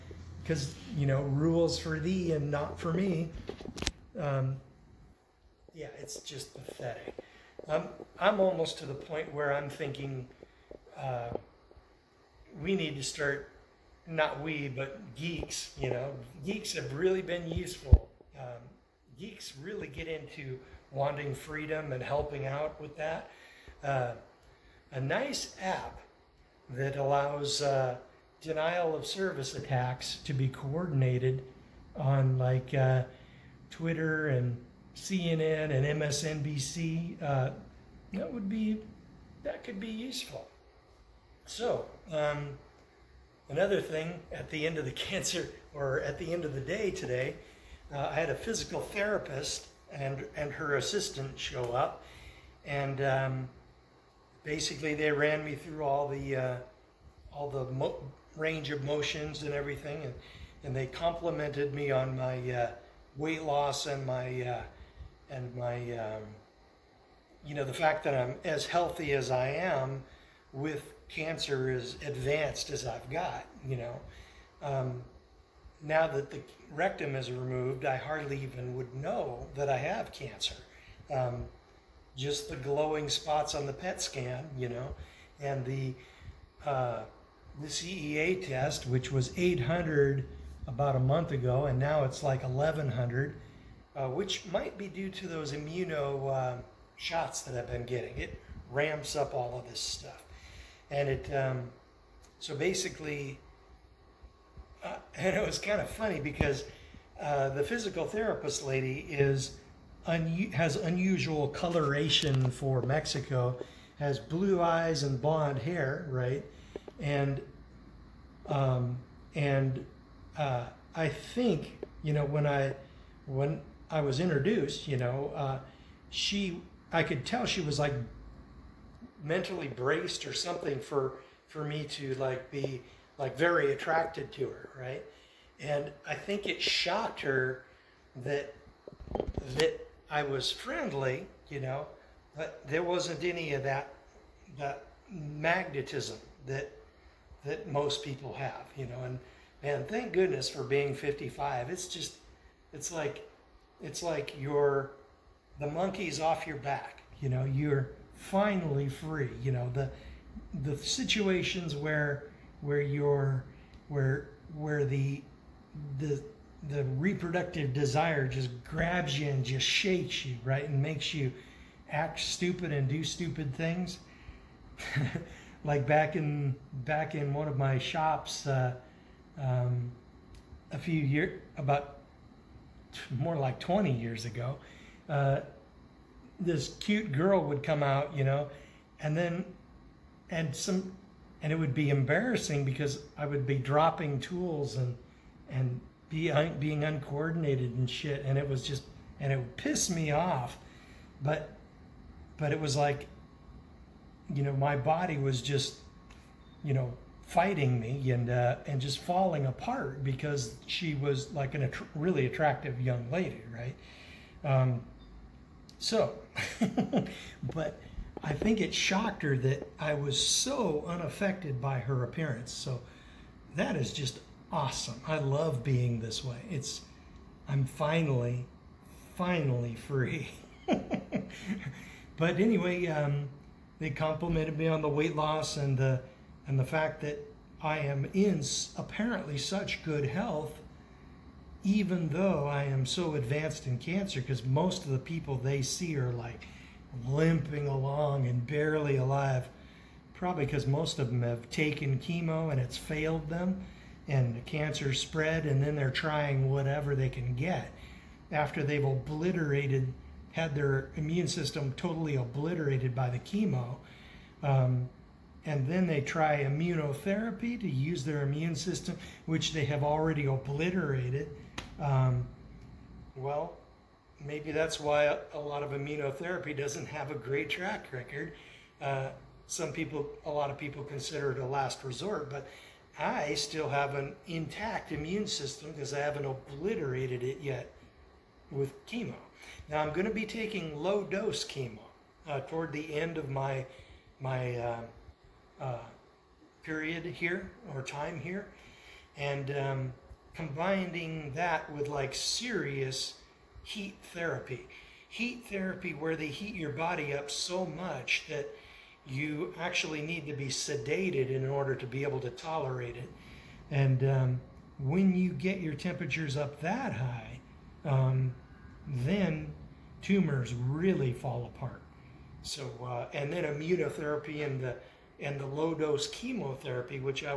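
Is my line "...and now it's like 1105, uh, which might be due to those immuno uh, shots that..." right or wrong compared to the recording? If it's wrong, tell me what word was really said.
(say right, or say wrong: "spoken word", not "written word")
wrong: "1100", not "1105".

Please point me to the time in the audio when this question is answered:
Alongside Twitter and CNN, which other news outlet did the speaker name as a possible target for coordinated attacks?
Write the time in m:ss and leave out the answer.
0:36.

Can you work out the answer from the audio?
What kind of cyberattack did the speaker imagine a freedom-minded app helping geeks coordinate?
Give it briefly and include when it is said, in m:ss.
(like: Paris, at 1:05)
denial of service, at 0:28.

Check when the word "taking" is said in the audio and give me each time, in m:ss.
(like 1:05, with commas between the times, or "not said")
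4:50.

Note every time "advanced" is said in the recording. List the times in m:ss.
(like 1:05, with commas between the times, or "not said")
1:12, 4:03.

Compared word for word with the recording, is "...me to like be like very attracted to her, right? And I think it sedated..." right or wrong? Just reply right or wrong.
wrong.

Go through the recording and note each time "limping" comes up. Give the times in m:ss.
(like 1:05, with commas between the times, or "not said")
4:07.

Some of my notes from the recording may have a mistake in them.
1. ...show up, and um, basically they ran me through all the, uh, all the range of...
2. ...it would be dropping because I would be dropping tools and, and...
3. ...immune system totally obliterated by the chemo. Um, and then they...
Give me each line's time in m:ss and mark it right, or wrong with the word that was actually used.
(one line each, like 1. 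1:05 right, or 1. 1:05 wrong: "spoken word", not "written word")
1. 0:51 right
2. 3:11 wrong: "embarrassing", not "dropping"
3. 4:20 right.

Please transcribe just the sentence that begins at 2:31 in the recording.
It's just it's like it's like you're the monkey's off your back, you know.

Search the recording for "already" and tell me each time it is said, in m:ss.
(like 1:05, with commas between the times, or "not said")
4:29.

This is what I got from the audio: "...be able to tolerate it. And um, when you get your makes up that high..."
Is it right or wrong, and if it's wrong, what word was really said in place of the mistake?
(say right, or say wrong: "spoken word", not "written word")
wrong: "temperatures", not "makes".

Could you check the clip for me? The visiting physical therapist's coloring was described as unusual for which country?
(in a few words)
Mexico.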